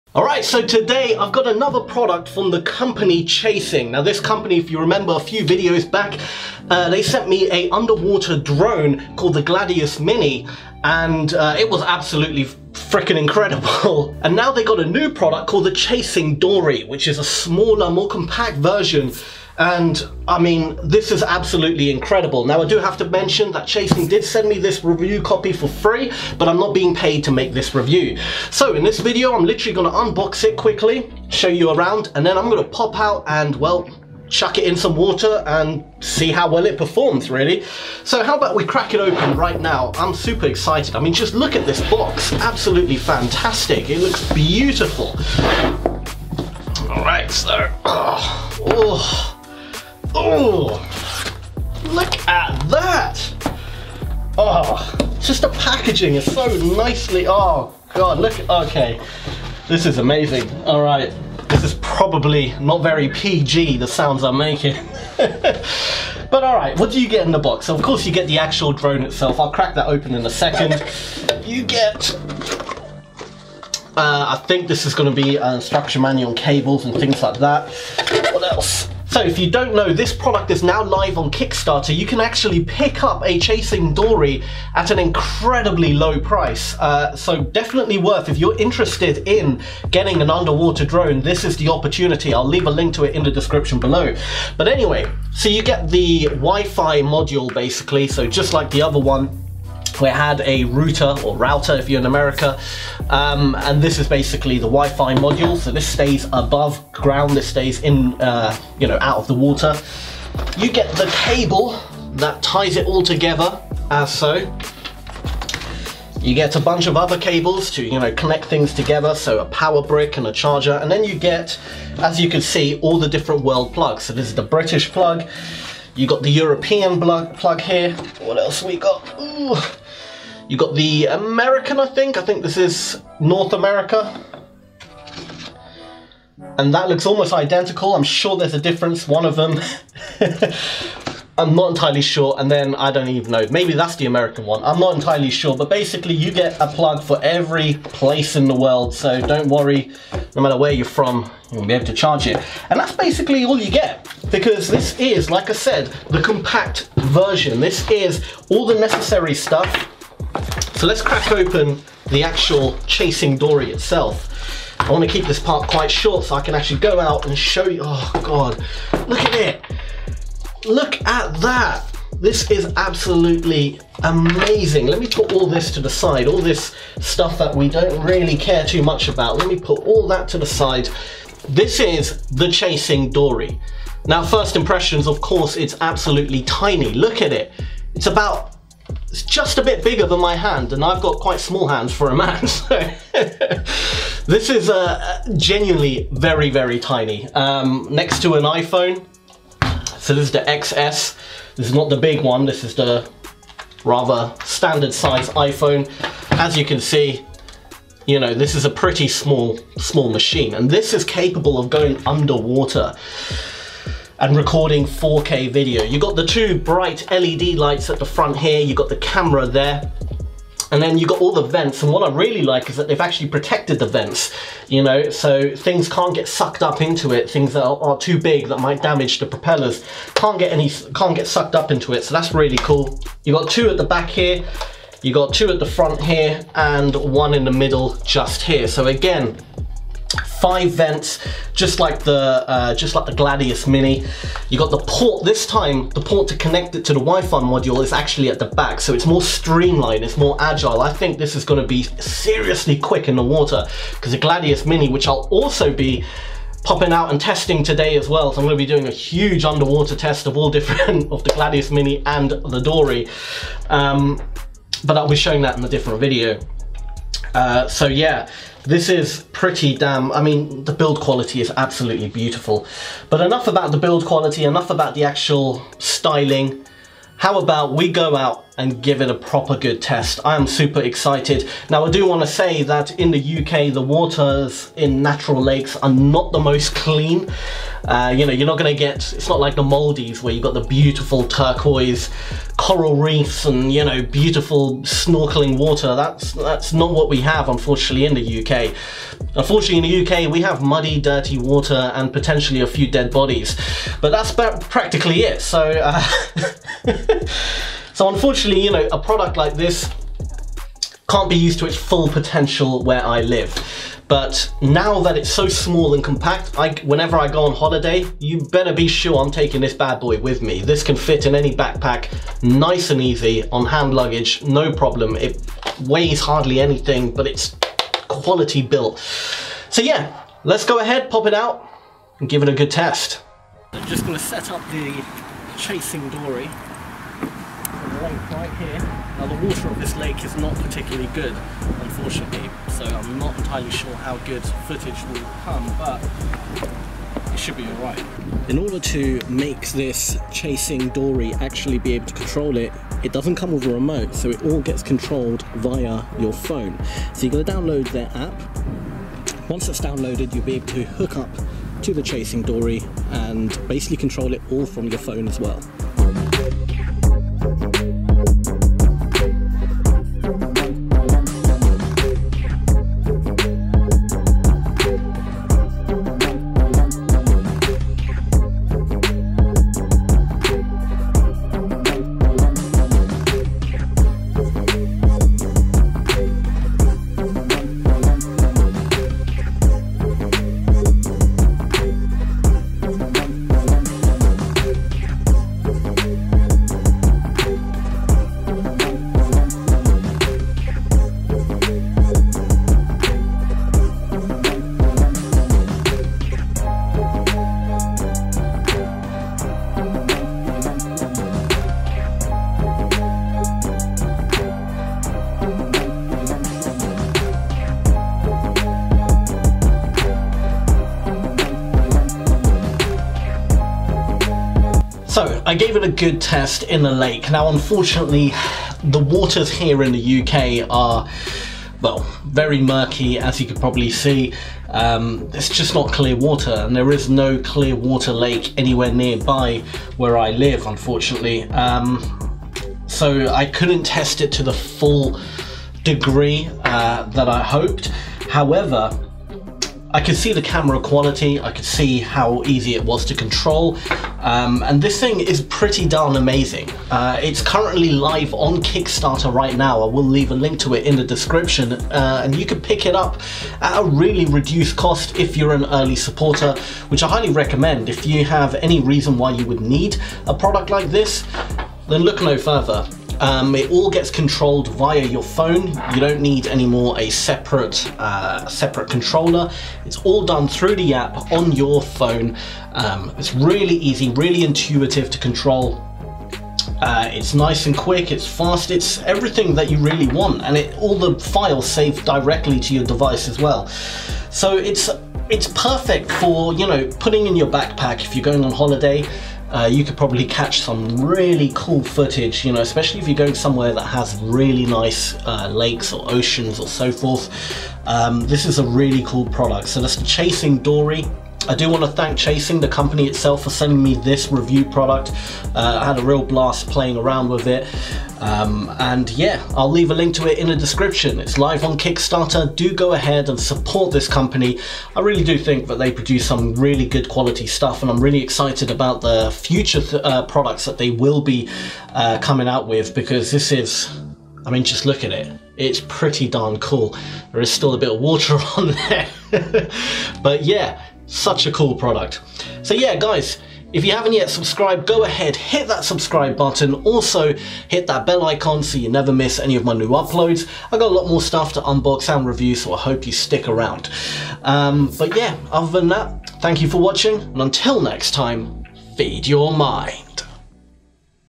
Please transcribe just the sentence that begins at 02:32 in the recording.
And that's basically all you get, because this is, like I said, the compact version.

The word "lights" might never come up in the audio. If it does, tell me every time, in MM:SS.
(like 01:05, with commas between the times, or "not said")
03:37.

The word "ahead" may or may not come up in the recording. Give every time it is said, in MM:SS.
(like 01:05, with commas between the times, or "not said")
05:30, 08:42, 09:05.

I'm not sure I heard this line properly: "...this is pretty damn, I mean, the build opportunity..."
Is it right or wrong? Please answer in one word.
wrong.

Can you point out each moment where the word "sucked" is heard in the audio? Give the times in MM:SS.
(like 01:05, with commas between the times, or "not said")
03:46, 03:51.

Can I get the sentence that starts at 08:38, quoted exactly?
Um, and yeah, I'll leave a link to it in the description.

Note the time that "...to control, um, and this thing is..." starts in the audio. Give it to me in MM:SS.
07:33.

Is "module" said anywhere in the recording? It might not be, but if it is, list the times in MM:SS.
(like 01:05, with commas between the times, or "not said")
01:37, 01:45, 04:07.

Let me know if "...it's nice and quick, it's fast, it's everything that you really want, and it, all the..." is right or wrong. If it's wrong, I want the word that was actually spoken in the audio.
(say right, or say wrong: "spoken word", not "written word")
right.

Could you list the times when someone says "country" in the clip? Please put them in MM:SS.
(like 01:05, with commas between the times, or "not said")
not said.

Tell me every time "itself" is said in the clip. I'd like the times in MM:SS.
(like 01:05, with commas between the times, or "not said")
01:09, 02:43, 08:33.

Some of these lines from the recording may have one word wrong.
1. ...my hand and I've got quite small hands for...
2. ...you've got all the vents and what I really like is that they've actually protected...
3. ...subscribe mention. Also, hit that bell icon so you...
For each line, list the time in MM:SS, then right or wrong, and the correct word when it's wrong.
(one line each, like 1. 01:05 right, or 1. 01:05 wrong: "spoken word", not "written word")
1. 03:10 right
2. 03:40 right
3. 09:05 wrong: "button", not "mention".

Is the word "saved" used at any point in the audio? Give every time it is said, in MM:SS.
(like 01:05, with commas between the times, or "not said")
08:11.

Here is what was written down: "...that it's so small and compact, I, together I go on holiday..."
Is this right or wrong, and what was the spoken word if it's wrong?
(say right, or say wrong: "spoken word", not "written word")
wrong: "whenever", not "together".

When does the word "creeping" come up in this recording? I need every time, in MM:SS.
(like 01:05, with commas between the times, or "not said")
not said.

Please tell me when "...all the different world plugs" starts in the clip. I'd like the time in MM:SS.
02:02.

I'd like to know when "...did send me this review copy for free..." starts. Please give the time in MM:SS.
00:24.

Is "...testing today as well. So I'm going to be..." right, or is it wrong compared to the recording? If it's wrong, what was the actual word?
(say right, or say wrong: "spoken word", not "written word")
right.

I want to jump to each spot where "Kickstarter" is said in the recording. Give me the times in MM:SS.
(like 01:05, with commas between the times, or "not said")
01:21, 07:38, 08:41.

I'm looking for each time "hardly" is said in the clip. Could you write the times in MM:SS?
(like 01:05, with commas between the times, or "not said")
05:26.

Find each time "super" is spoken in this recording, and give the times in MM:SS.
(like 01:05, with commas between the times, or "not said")
00:40, 04:40.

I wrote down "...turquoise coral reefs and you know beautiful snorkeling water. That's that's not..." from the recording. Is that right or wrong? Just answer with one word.
right.